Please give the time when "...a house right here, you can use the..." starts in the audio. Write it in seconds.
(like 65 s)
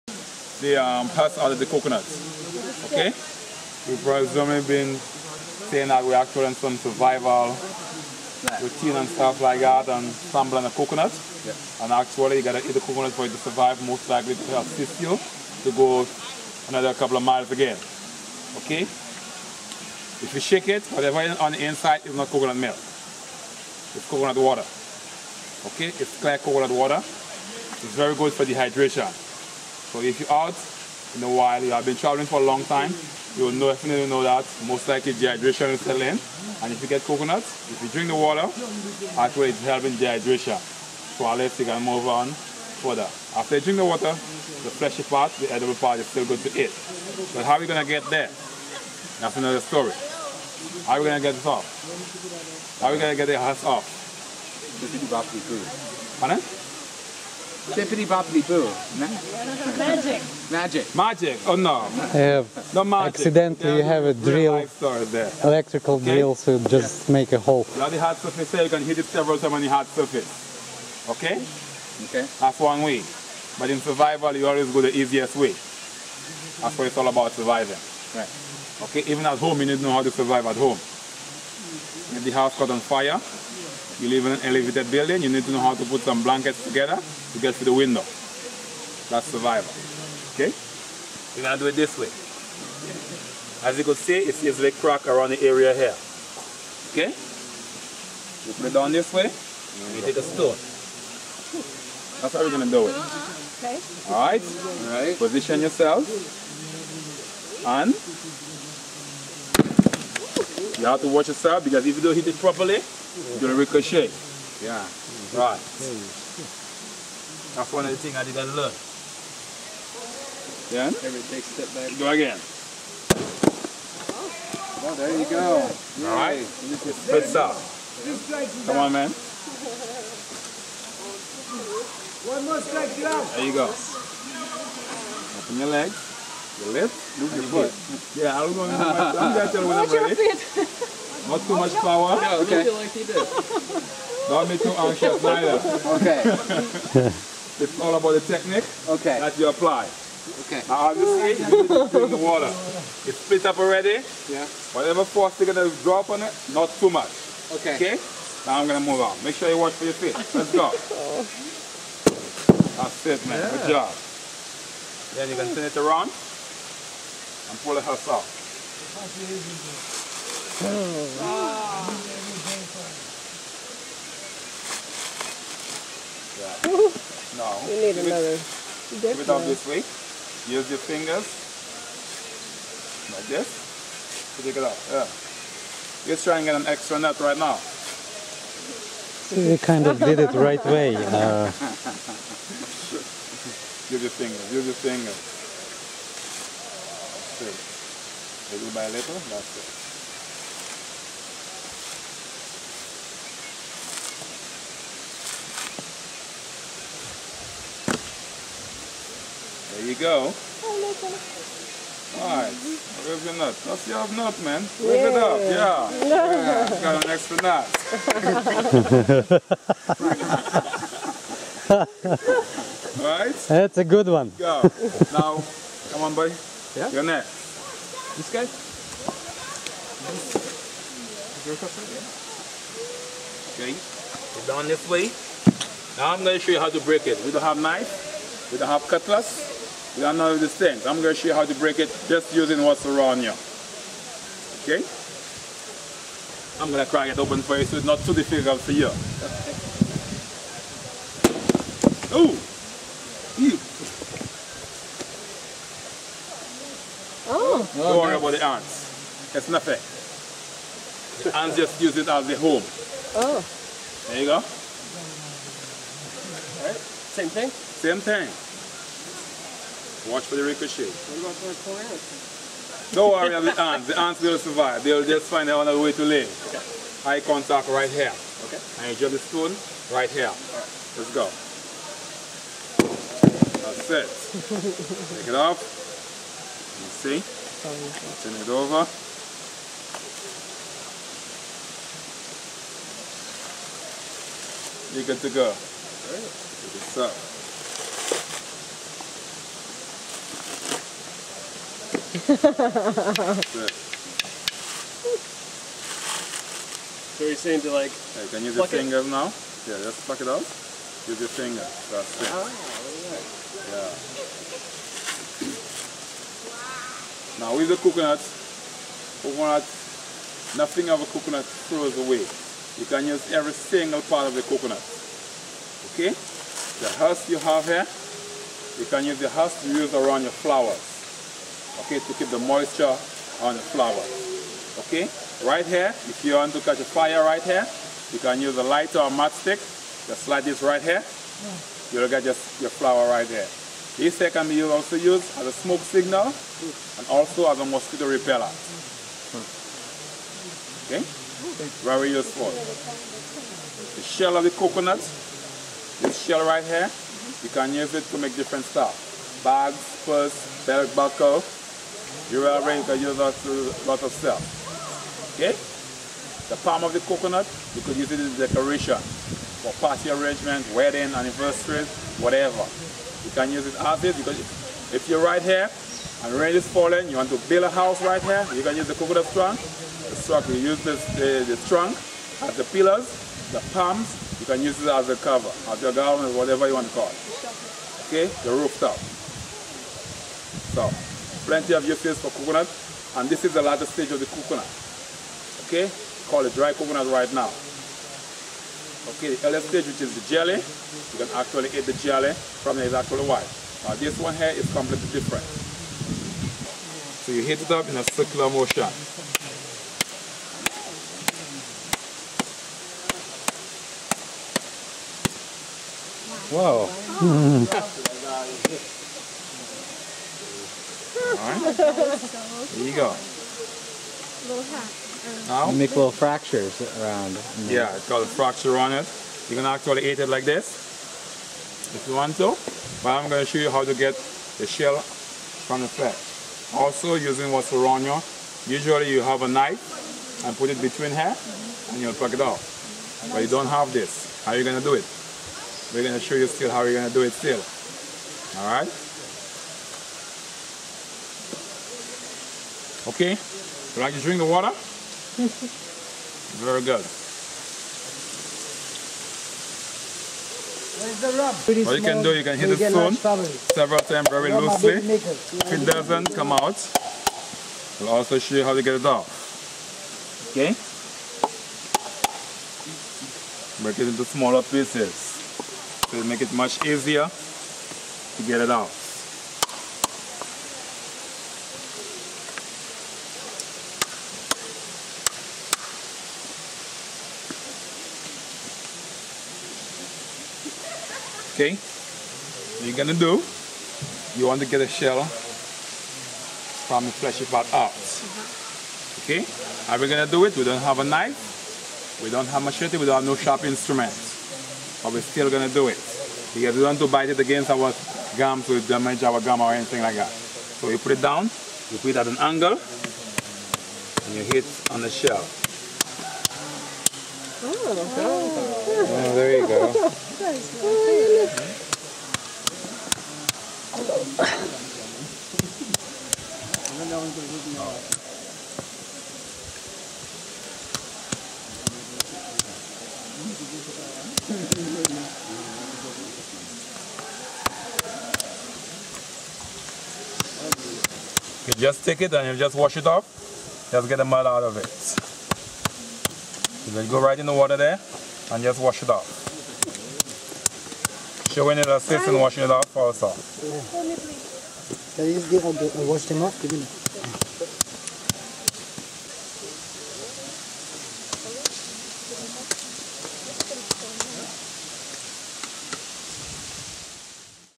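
377 s.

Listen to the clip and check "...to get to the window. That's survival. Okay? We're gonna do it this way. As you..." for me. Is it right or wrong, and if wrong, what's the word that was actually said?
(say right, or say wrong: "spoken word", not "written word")
right.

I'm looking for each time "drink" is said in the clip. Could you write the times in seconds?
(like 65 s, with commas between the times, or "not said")
37 s, 43 s, 454 s.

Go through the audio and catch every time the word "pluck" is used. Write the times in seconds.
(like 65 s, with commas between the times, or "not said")
310 s, 442 s.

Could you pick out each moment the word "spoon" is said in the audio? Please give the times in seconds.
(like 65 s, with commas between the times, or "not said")
279 s, 462 s.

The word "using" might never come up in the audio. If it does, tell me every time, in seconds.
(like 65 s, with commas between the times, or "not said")
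242 s, 437 s.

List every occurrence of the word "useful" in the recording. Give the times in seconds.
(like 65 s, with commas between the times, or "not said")
352 s.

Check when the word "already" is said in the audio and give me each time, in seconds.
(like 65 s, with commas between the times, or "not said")
153 s.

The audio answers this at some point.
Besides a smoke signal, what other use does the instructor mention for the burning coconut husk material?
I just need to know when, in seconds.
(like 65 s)
347 s.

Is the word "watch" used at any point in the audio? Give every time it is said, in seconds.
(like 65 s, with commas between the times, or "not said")
111 s, 159 s, 270 s.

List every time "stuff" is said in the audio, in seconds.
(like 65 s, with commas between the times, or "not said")
9 s, 358 s, 364 s.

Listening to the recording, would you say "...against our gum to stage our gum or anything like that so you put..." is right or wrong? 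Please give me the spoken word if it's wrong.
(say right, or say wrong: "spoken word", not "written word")
wrong: "damage", not "stage".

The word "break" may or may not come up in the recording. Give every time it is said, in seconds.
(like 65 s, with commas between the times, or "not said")
236 s, 241 s, 473 s.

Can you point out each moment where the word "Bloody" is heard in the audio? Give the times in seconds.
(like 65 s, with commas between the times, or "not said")
67 s.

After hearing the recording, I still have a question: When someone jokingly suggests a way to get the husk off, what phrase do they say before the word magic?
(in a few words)
Bippity boppity boo.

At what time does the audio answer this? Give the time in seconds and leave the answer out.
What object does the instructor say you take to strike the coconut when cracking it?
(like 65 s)
99 s.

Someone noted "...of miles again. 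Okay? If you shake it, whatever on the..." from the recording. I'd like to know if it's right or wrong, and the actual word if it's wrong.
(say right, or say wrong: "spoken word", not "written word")
right.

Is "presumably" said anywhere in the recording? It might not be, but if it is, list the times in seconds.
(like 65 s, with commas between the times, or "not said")
4 s.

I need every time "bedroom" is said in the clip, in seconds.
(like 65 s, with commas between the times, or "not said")
not said.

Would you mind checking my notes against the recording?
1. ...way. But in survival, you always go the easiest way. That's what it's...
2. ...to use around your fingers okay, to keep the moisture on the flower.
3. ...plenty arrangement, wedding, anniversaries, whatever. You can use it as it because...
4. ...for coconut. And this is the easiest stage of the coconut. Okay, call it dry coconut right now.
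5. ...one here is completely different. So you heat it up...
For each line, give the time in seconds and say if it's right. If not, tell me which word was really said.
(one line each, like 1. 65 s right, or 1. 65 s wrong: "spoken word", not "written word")
1. 72 s right
2. 329 s wrong: "flowers", not "fingers"
3. 369 s wrong: "party", not "plenty"
4. 392 s wrong: "largest", not "easiest"
5. 404 s right.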